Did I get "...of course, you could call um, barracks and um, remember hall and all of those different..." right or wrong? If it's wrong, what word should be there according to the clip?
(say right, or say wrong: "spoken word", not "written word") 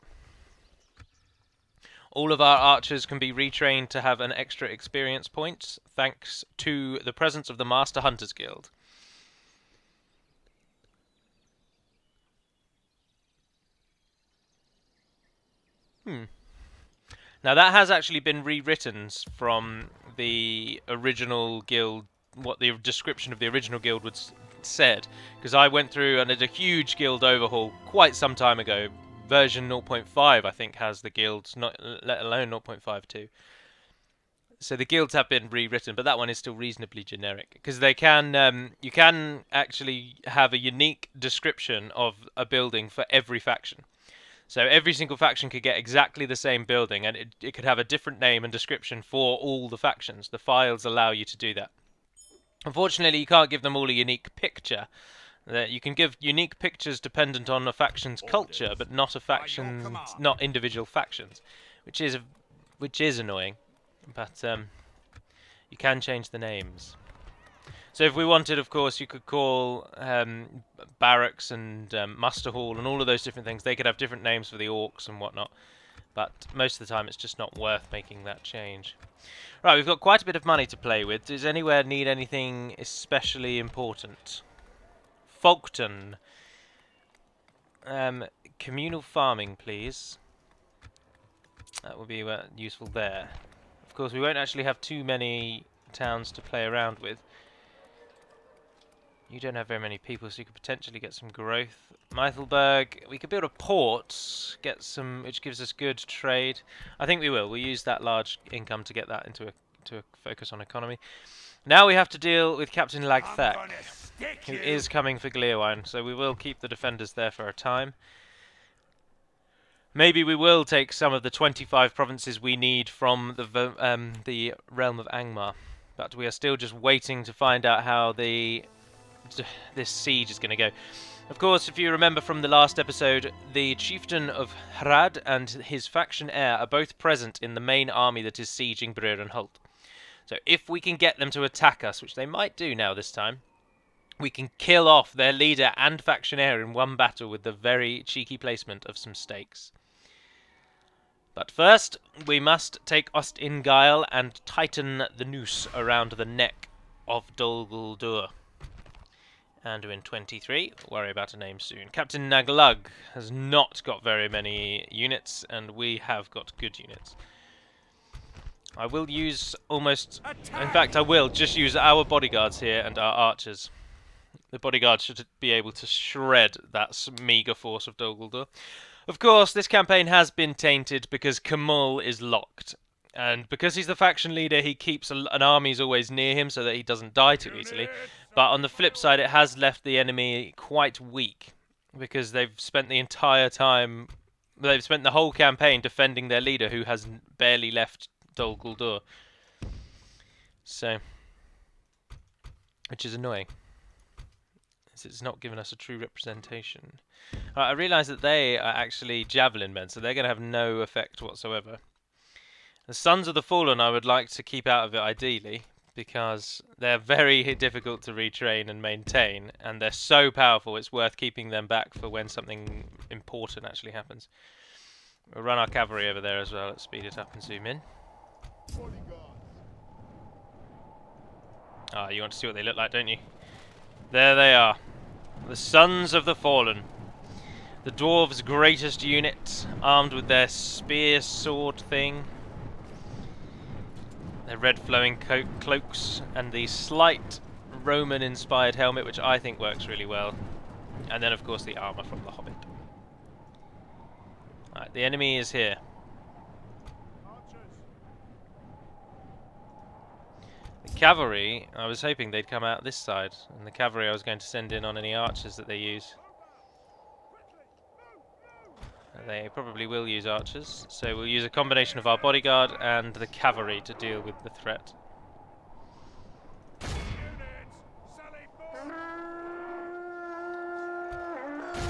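wrong: "muster", not "remember".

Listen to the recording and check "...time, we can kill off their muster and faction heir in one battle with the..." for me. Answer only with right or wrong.
wrong.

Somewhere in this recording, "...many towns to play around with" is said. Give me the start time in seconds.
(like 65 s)
95 s.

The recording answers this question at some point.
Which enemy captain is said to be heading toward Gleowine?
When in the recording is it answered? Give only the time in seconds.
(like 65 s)
112 s.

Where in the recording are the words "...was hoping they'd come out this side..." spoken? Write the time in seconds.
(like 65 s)
261 s.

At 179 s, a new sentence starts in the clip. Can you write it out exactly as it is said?
Of course, this campaign has been tainted because Khamûl is locked.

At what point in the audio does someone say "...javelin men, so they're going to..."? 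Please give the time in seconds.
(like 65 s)
209 s.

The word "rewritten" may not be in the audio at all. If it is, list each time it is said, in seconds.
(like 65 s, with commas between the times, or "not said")
18 s, 35 s.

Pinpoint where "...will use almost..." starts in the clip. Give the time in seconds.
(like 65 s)
168 s.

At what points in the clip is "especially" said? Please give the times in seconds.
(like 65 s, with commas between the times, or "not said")
82 s.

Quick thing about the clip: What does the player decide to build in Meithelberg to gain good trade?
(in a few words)
A port.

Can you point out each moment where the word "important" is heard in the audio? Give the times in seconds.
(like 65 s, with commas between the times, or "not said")
83 s, 223 s.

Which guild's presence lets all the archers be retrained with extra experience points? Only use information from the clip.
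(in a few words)
Master Hunters Guild.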